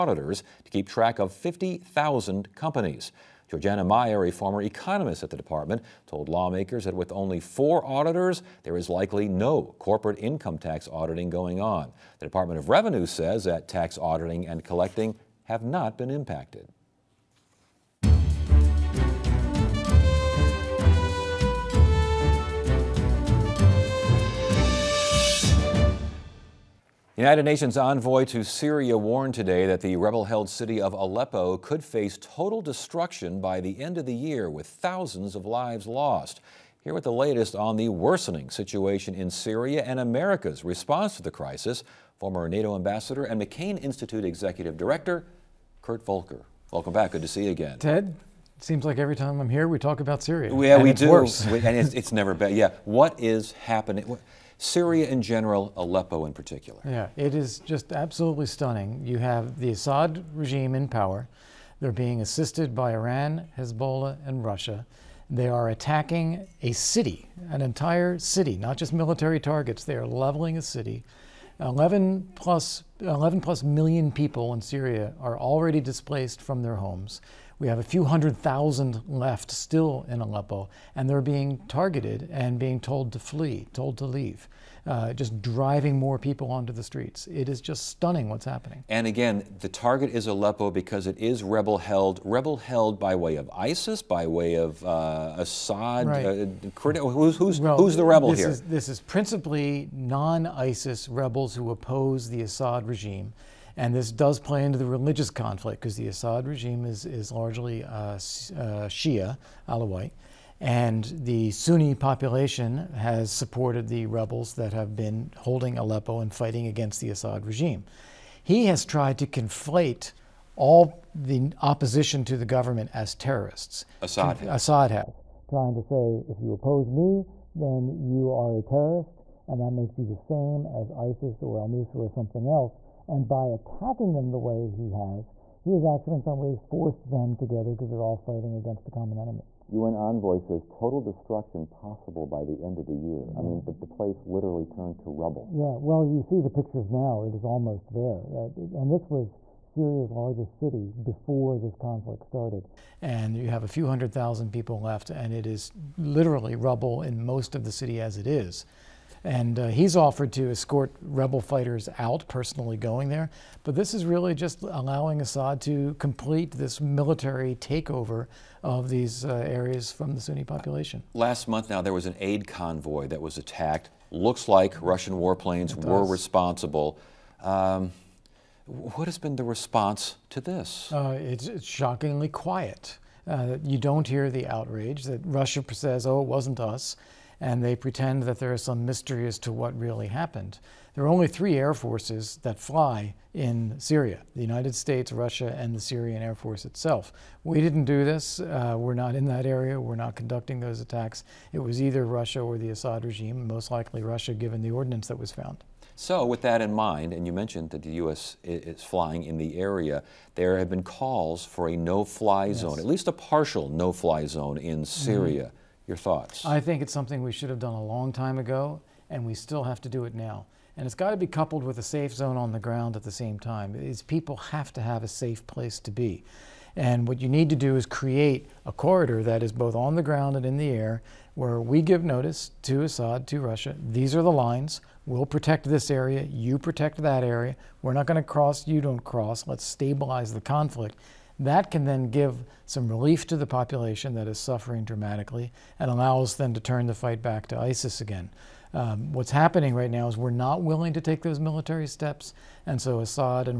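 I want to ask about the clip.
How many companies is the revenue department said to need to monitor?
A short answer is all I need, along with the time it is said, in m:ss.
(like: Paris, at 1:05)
50,000, at 0:01.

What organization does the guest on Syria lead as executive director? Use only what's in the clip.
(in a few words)
McCain Institute.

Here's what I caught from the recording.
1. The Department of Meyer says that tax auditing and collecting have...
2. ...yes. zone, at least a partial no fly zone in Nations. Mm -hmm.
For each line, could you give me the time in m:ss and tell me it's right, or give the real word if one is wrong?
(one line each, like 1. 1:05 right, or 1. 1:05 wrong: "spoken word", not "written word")
1. 0:12 wrong: "Revenue", not "Meyer"
2. 3:32 wrong: "Syria", not "Nations".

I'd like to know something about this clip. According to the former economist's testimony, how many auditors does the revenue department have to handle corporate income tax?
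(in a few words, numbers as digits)
4.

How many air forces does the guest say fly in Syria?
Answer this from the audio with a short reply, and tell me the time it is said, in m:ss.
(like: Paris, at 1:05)
3, at 3:11.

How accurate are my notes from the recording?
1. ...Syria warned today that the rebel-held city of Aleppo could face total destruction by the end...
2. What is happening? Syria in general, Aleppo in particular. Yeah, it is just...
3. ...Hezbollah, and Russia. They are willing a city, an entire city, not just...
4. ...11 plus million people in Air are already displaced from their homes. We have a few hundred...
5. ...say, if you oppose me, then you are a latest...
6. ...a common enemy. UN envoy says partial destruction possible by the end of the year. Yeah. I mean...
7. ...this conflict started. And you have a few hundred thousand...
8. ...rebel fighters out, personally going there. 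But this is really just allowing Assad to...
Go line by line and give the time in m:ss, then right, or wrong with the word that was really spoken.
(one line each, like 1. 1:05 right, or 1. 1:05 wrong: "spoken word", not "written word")
1. 0:28 right
2. 0:52 right
3. 1:03 wrong: "attacking", not "willing"
4. 1:13 wrong: "Syria", not "Air"
5. 2:05 wrong: "terrorist", not "latest"
6. 2:18 wrong: "total", not "partial"
7. 2:31 right
8. 2:41 right.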